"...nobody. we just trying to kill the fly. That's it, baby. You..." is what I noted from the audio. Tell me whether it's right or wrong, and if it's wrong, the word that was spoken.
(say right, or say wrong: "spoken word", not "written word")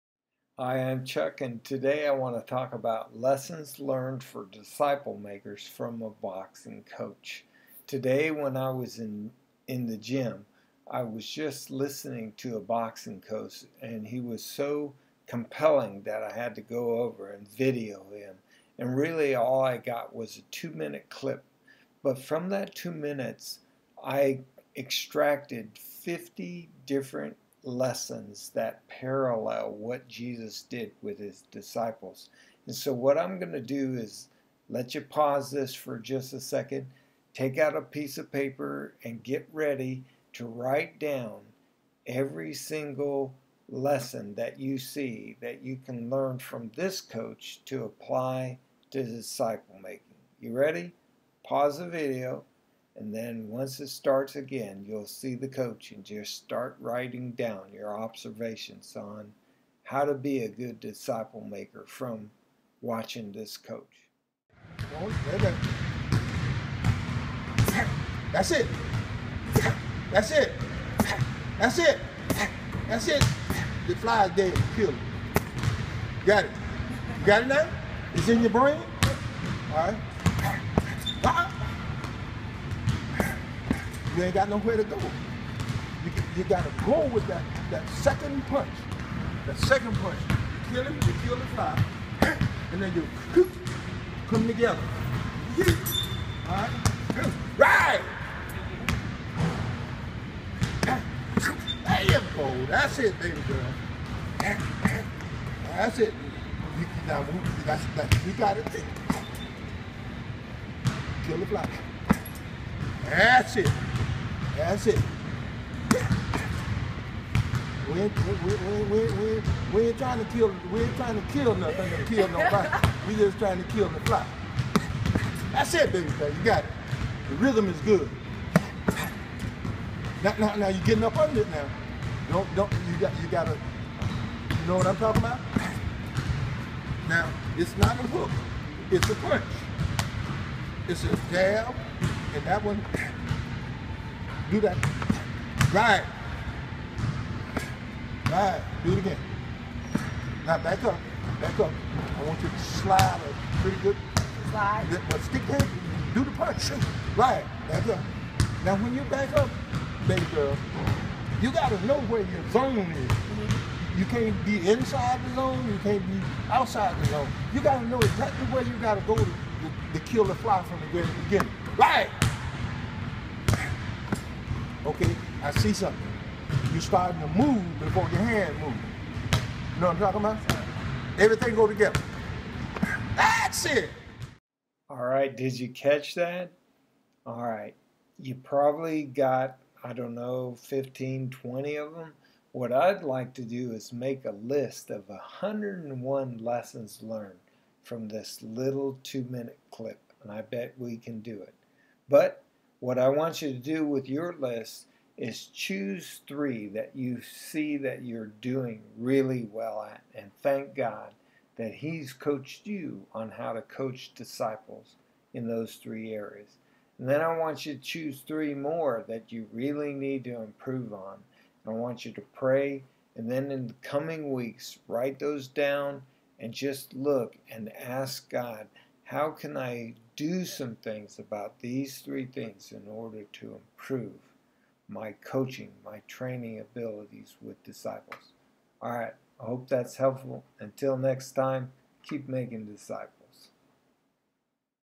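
right.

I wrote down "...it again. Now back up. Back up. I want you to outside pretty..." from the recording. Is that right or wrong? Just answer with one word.
wrong.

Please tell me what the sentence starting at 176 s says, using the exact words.
You're starting to move before your hand moves.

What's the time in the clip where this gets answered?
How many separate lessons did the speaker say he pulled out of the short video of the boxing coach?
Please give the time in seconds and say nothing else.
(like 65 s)
25 s.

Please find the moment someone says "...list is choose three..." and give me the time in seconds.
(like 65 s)
204 s.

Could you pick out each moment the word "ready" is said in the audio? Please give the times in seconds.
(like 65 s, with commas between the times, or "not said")
39 s, 50 s.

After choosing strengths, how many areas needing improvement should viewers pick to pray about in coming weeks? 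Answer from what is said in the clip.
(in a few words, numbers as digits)
3.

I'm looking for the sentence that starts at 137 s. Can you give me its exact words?
Now, it's not a hook, it's a punch.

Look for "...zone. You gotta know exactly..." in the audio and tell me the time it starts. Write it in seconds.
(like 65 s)
167 s.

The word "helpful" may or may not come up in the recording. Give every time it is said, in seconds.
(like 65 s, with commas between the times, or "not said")
239 s.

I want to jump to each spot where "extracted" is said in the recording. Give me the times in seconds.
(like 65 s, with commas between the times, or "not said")
24 s.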